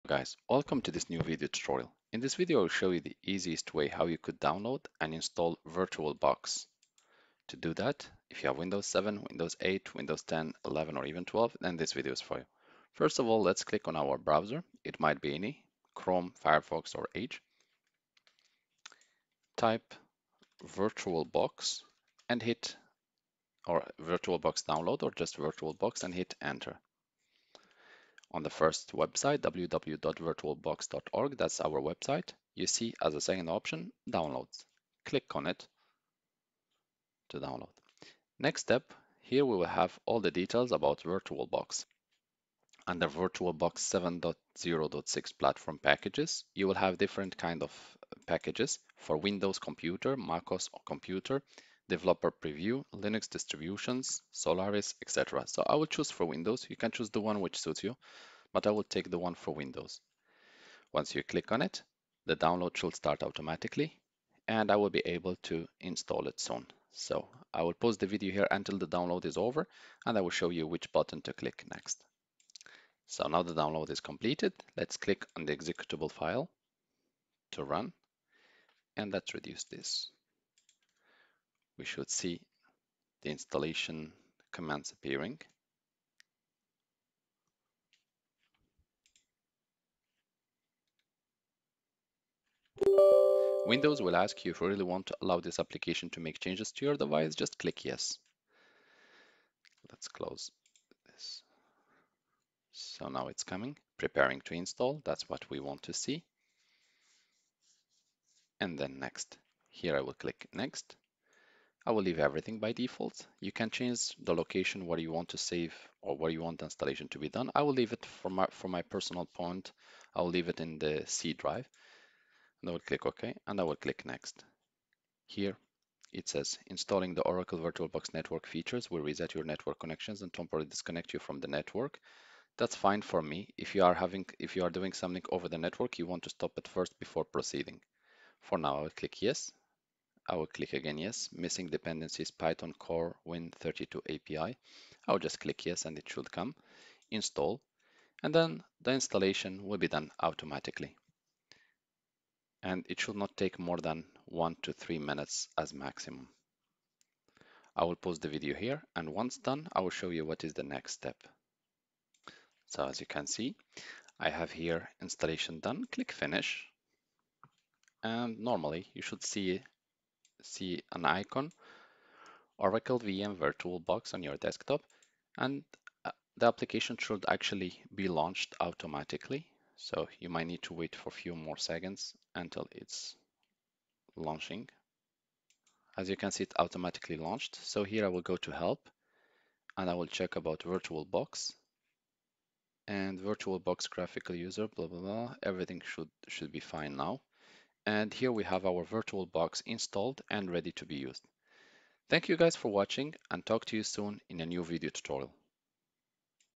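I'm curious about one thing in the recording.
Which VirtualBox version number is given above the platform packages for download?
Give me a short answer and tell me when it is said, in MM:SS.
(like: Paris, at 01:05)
7.0.6, at 00:43.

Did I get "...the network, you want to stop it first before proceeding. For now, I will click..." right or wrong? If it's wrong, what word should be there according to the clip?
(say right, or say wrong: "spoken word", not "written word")
right.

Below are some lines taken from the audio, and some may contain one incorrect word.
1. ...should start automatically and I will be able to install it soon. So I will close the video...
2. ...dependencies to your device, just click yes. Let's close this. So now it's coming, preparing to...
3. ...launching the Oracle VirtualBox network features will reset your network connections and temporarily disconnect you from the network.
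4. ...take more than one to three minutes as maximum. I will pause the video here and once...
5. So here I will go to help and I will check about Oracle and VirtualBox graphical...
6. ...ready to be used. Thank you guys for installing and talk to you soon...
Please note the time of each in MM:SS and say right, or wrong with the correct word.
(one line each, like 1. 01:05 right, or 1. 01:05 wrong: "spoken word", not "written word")
1. 01:02 wrong: "pause", not "close"
2. 01:36 wrong: "changes", not "dependencies"
3. 02:06 wrong: "installing", not "launching"
4. 02:33 right
5. 03:07 wrong: "VirtualBox", not "Oracle"
6. 03:20 wrong: "watching", not "installing".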